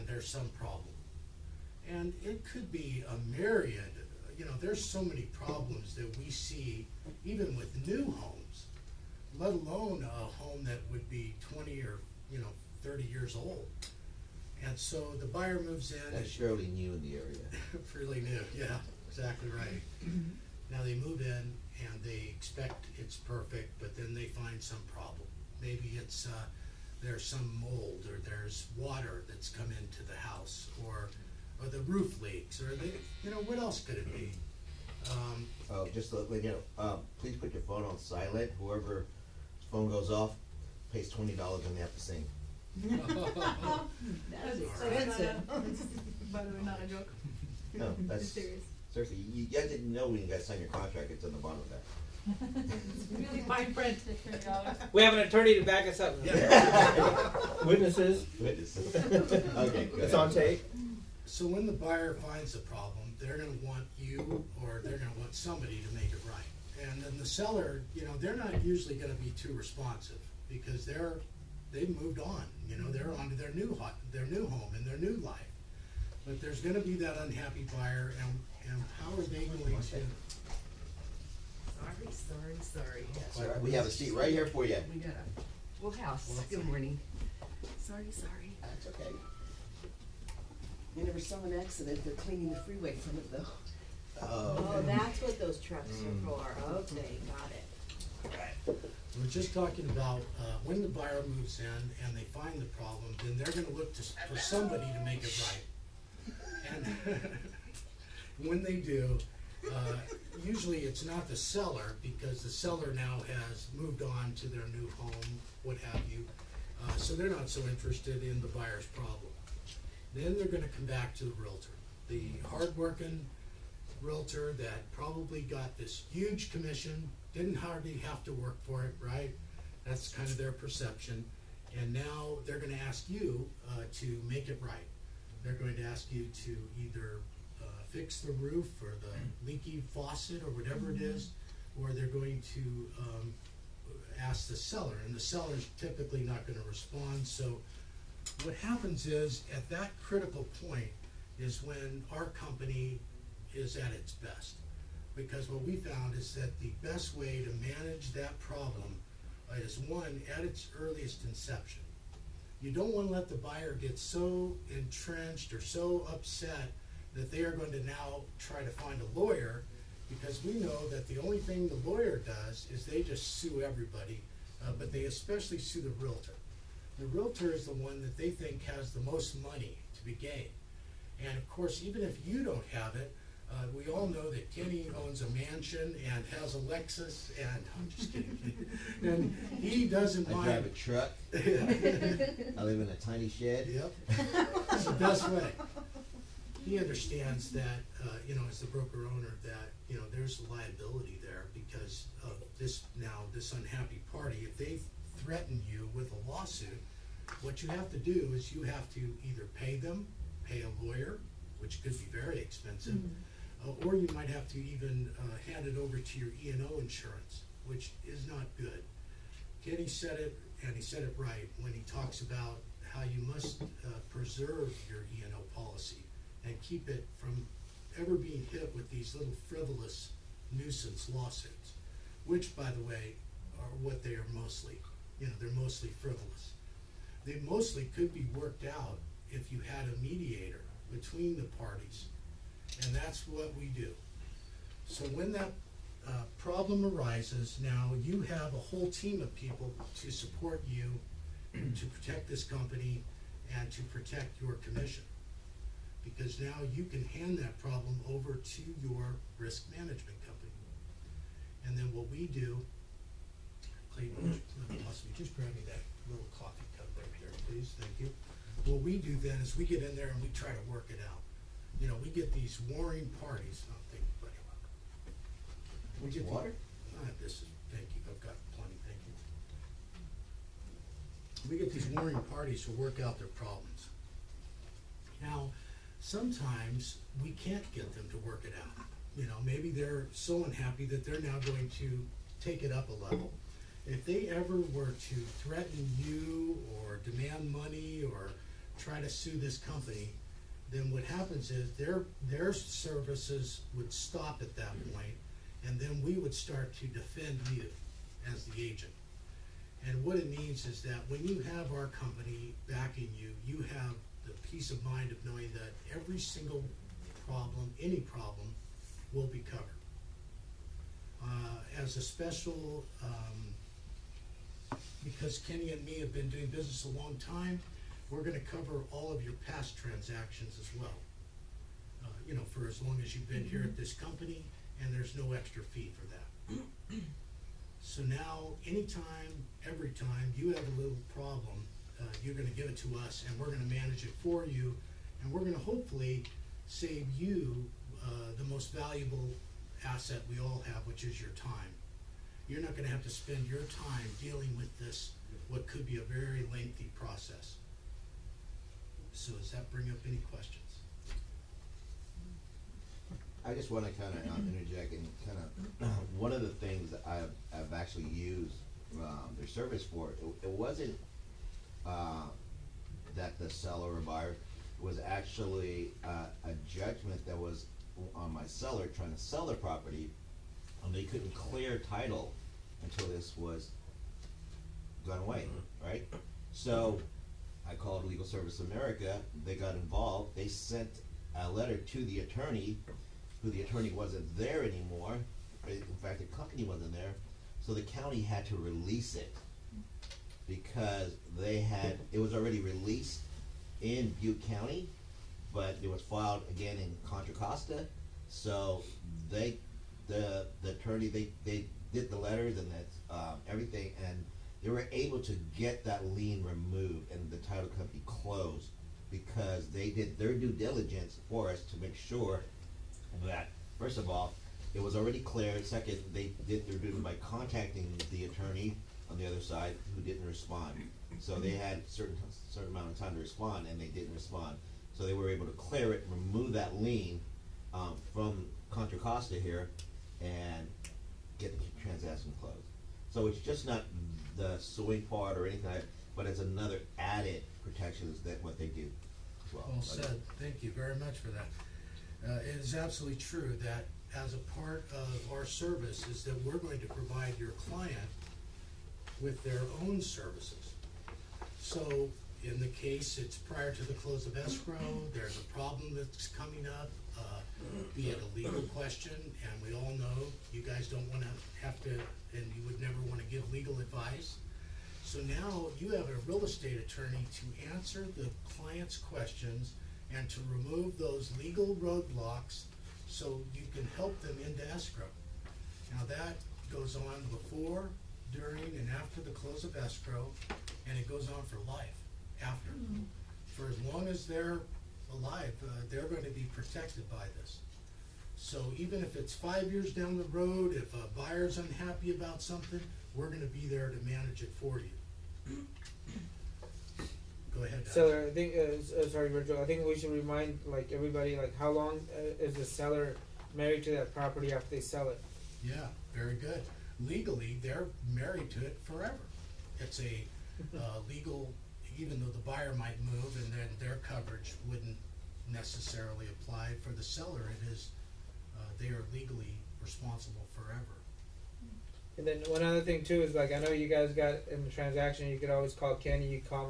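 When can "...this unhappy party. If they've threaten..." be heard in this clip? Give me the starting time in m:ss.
3:23.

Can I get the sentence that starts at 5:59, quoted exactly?
So does that bring up any questions?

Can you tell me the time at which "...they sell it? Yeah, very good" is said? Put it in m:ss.
8:34.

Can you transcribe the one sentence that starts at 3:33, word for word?
uh, or you might have to even uh, hand it over to your E&O insurance, which is not good.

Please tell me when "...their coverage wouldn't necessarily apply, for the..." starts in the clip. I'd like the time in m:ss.
8:43.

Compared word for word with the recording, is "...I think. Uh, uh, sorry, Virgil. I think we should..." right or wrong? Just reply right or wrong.
right.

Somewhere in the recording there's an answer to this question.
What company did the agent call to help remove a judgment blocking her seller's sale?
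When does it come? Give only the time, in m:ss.
6:28.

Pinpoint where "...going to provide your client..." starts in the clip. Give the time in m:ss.
7:36.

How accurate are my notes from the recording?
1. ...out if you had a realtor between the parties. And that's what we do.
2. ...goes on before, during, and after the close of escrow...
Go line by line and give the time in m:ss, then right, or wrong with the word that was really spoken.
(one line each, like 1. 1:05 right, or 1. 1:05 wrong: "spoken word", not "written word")
1. 3:58 wrong: "mediator", not "realtor"
2. 8:06 right.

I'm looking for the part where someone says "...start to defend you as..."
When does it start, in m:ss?
5:06.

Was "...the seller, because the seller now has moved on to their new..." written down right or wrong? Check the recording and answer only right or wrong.
right.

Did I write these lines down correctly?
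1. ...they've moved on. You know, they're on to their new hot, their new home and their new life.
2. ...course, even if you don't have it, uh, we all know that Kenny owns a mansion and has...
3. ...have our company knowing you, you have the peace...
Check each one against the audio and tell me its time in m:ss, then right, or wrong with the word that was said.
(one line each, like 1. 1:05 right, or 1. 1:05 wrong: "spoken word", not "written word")
1. 1:11 right
2. 3:01 right
3. 5:11 wrong: "backing", not "knowing".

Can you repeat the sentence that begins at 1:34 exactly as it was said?
Oh, oh that's what those trucks are mm.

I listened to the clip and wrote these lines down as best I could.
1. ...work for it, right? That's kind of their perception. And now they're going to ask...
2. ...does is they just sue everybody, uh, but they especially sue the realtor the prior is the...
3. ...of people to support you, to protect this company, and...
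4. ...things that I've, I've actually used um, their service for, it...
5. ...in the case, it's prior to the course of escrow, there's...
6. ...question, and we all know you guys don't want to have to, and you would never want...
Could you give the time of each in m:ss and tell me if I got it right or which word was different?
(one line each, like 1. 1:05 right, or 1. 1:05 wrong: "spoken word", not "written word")
1. 2:08 right
2. 2:52 wrong: "realtor", not "prior"
3. 4:09 right
4. 6:06 right
5. 7:42 wrong: "close", not "course"
6. 7:48 right.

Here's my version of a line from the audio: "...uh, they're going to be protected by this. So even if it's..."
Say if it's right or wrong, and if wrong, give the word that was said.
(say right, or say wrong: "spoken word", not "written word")
right.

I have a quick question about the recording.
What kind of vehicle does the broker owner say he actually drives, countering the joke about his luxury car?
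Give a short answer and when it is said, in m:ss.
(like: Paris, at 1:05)
A truck, at 3:10.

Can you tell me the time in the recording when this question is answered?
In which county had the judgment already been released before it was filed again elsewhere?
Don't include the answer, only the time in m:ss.
6:44.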